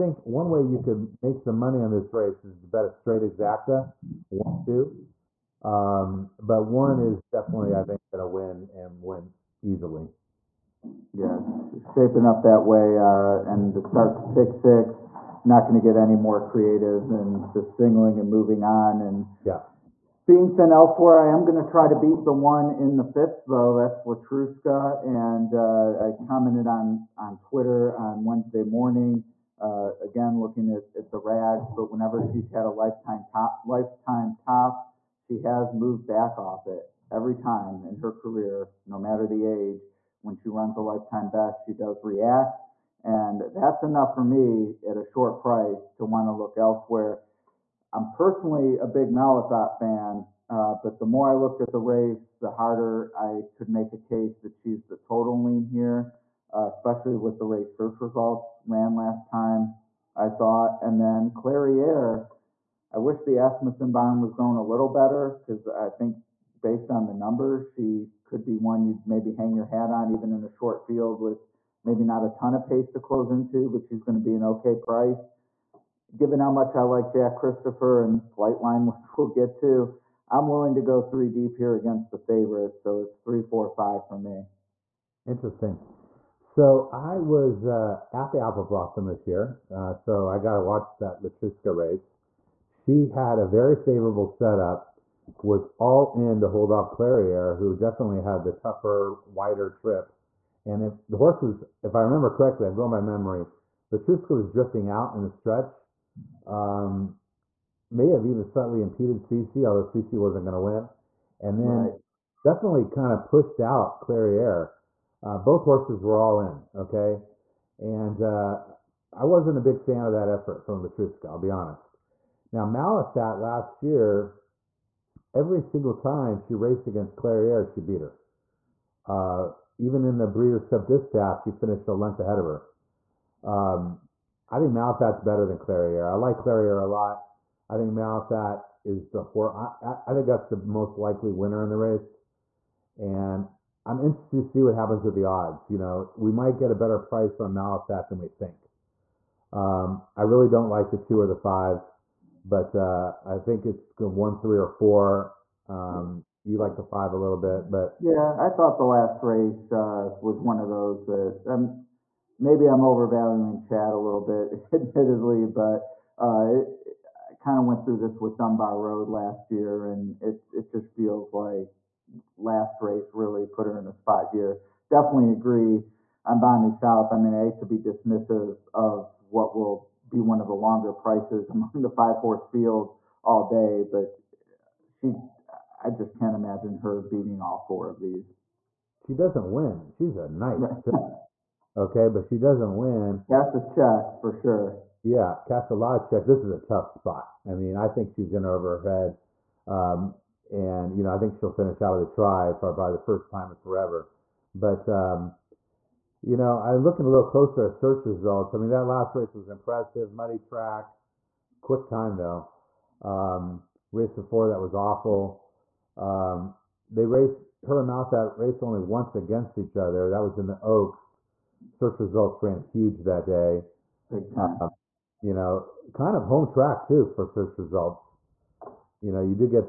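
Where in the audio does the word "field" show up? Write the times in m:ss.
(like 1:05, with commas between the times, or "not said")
1:10, 3:02.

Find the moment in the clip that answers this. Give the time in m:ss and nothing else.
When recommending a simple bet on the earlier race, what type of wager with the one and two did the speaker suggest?
0:02.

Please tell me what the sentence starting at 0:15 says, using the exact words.
Not going to get any more creative than just singling and moving on.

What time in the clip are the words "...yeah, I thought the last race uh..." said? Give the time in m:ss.
2:38.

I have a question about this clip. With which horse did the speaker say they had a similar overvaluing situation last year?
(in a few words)
Dunbar Road.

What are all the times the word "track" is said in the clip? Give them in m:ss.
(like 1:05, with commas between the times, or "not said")
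3:30, 3:46.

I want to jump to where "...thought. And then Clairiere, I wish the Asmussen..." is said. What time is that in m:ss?
1:00.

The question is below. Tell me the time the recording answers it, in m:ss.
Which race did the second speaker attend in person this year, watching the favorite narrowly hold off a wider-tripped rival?
1:28.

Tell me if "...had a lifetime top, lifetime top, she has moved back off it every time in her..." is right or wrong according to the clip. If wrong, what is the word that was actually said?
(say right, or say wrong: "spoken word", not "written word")
right.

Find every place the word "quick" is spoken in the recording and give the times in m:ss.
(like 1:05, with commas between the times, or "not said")
3:31.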